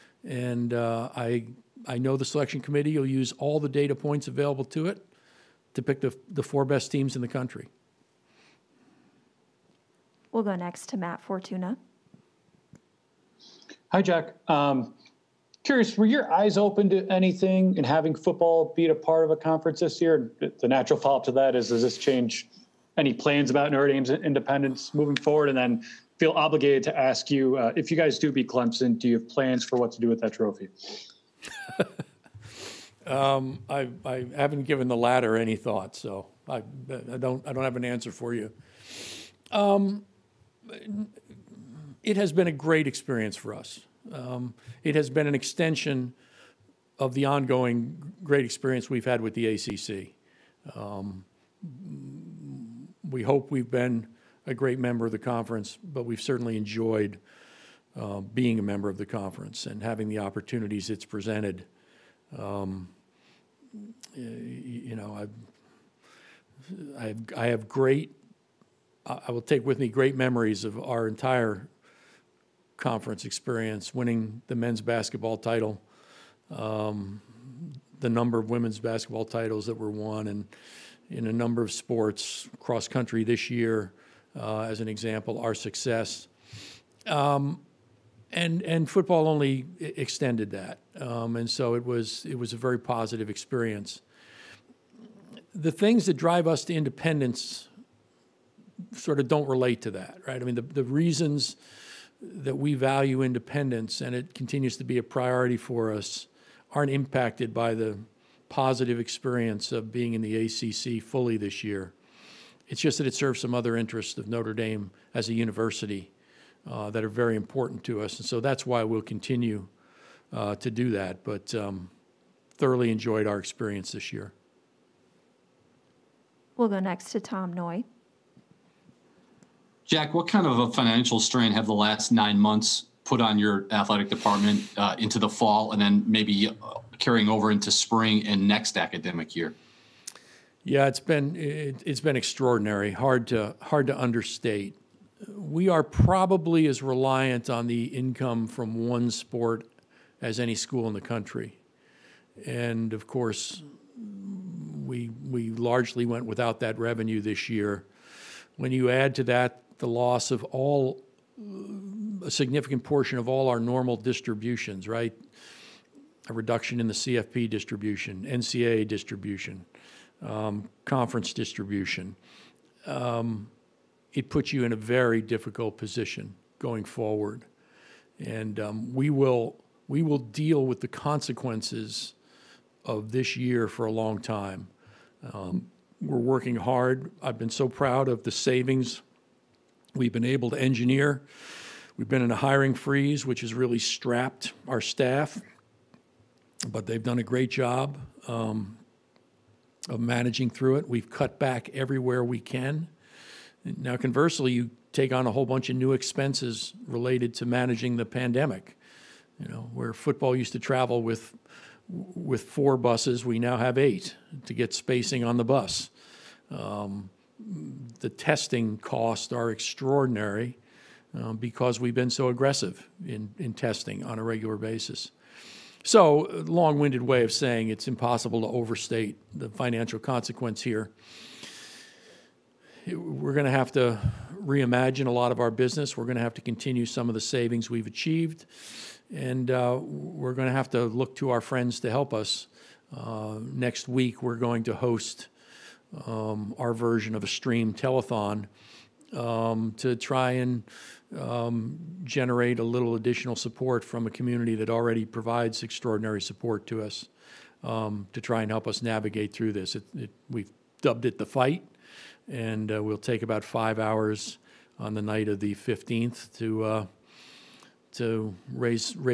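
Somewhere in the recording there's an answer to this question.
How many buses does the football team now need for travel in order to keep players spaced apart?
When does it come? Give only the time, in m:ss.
3:33.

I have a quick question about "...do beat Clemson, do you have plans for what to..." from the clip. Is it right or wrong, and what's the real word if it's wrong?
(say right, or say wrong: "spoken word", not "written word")
right.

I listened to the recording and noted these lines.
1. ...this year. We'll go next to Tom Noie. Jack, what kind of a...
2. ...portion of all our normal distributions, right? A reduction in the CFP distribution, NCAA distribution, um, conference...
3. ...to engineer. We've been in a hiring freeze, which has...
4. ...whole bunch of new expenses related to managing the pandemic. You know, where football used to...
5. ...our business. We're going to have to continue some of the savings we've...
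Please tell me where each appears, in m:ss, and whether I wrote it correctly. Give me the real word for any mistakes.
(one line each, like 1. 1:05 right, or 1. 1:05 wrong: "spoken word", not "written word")
1. 2:03 right
2. 2:42 right
3. 3:10 right
4. 3:25 right
5. 3:55 right.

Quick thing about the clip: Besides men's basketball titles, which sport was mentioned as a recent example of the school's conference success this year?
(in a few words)
cross country.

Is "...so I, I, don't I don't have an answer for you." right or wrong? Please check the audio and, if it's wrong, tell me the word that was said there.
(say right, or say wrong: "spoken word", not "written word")
right.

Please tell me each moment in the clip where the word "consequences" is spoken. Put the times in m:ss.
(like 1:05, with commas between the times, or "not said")
3:00, 3:49.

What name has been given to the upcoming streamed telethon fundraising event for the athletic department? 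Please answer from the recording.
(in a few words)
the fight.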